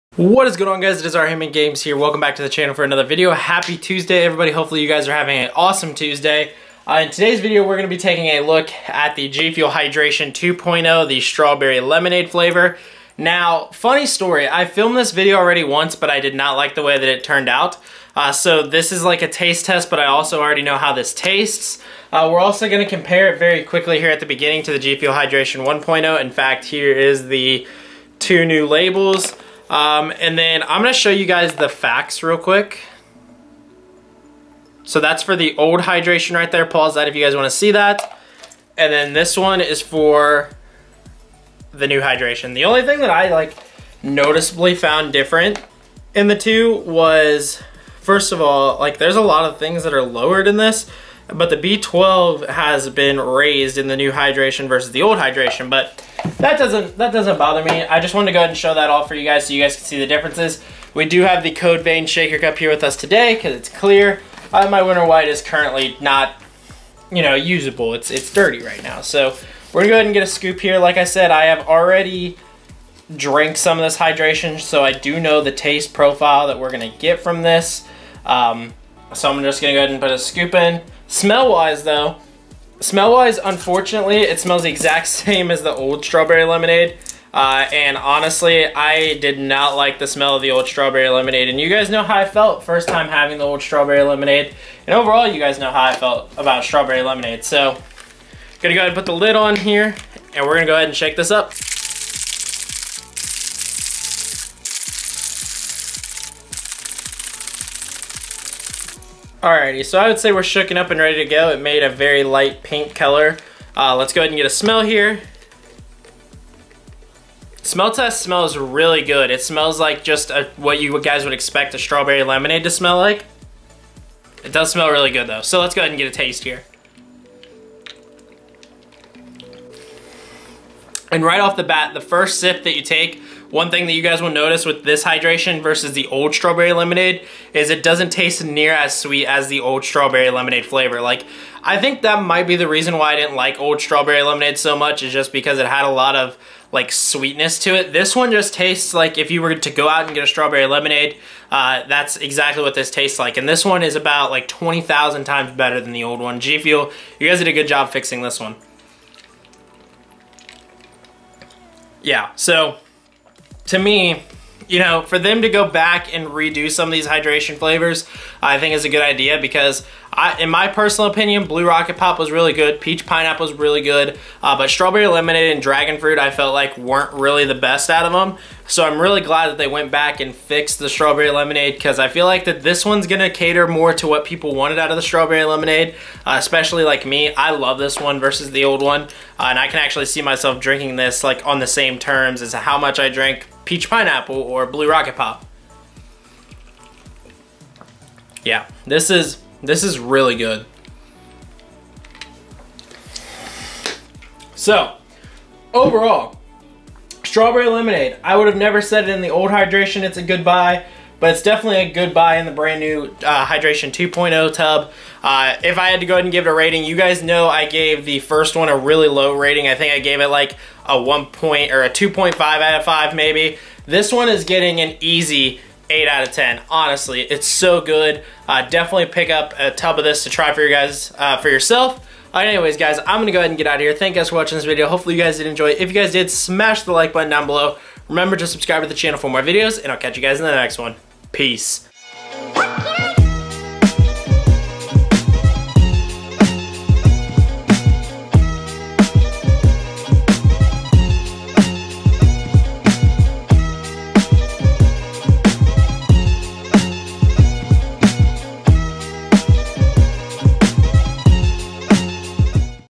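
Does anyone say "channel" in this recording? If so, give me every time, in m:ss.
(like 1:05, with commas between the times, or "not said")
0:02, 3:58.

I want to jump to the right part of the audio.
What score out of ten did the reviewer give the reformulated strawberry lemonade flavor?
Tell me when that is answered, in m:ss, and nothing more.
3:45.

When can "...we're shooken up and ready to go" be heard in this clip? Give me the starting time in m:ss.
1:50.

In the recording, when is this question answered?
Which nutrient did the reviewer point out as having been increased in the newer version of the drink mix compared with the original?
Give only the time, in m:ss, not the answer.
0:51.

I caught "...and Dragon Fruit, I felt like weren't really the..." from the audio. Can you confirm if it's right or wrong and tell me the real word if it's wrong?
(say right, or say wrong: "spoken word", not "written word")
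right.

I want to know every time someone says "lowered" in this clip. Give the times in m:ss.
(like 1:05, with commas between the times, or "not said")
0:50.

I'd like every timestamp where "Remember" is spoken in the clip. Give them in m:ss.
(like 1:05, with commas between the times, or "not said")
3:58.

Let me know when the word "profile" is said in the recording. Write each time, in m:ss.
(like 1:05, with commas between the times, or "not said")
1:15.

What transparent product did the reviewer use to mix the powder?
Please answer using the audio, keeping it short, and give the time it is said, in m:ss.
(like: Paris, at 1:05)
Code Vein Shaker Cup, at 1:01.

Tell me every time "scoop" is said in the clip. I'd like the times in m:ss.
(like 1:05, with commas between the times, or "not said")
1:10, 1:20.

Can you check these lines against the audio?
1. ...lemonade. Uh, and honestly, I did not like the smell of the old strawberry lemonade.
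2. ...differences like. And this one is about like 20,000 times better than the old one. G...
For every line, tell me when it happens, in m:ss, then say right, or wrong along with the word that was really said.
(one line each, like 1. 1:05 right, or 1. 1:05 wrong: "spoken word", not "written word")
1. 1:26 right
2. 2:32 wrong: "tastes", not "differences".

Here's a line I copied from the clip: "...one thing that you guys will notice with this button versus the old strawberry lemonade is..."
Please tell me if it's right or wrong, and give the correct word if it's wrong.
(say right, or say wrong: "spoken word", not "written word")
wrong: "hydration", not "button".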